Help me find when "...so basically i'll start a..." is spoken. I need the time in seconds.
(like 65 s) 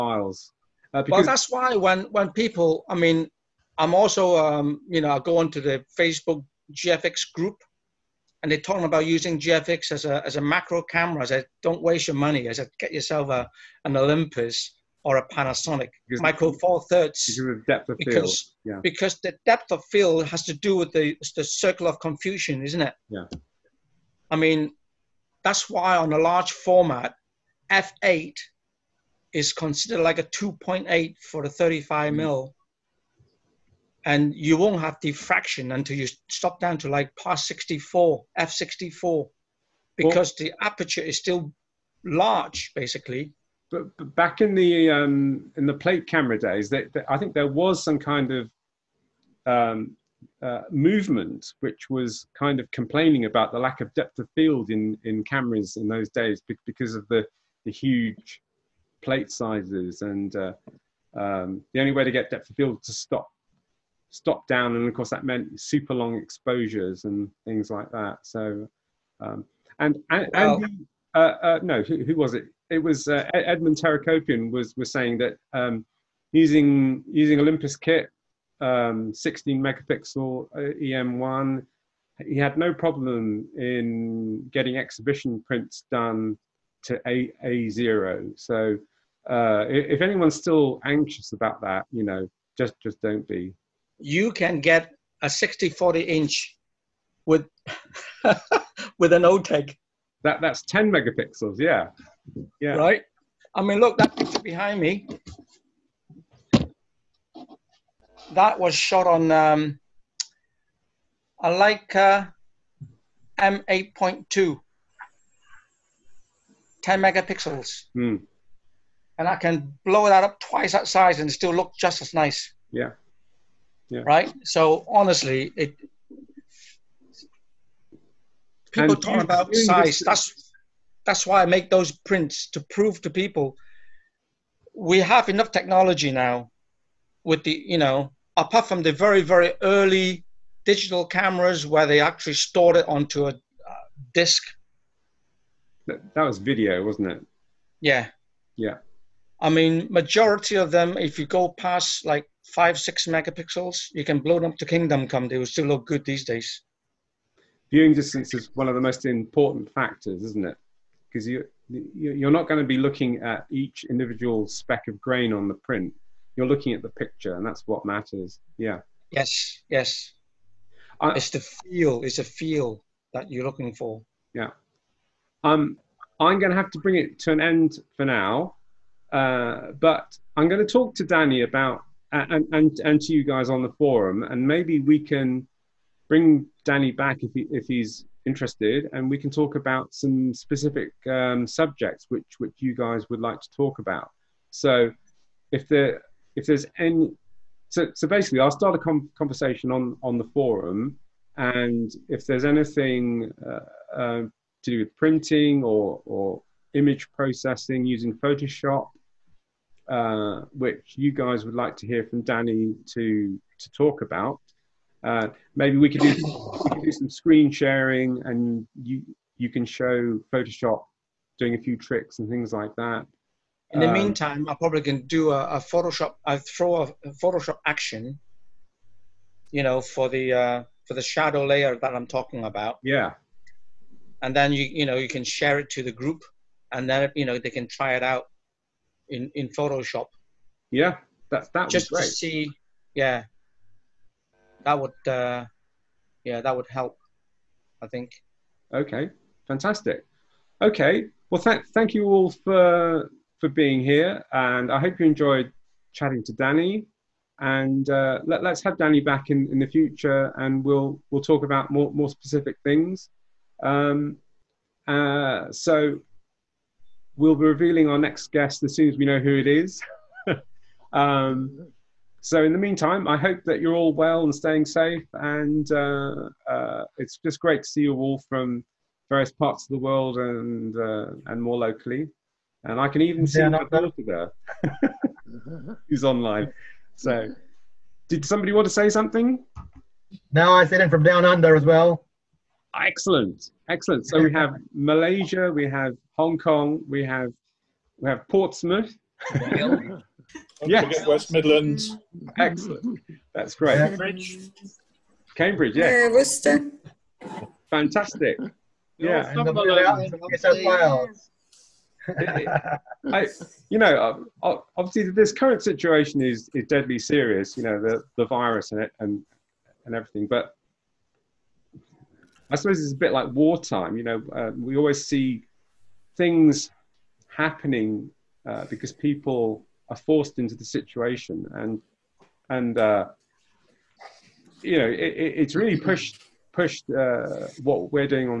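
197 s.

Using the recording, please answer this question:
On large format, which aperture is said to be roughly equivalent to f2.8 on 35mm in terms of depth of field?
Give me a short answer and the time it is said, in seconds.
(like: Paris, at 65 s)
f8, at 27 s.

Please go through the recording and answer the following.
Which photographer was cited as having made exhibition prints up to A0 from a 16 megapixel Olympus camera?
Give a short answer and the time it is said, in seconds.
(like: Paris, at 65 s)
Edmond Terakopian, at 73 s.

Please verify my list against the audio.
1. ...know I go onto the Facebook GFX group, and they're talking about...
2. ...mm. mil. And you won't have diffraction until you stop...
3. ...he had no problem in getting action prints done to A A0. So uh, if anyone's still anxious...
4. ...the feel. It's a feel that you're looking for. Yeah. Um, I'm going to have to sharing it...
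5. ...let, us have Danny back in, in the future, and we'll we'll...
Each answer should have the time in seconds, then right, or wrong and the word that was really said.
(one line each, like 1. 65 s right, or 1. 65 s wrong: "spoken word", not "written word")
1. 4 s right
2. 32 s right
3. 82 s wrong: "exhibition", not "action"
4. 171 s wrong: "bring", not "sharing"
5. 258 s right.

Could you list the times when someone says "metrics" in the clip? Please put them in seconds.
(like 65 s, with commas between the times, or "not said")
not said.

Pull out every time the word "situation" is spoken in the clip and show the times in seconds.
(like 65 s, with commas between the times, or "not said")
315 s, 330 s.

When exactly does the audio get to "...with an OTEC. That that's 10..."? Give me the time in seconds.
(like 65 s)
98 s.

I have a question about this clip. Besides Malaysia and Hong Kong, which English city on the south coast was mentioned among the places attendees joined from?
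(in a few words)
Portsmouth.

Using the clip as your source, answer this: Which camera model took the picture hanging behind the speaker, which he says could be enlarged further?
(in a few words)
Leica M8.2.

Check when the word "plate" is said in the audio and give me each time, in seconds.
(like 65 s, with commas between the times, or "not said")
45 s, 59 s.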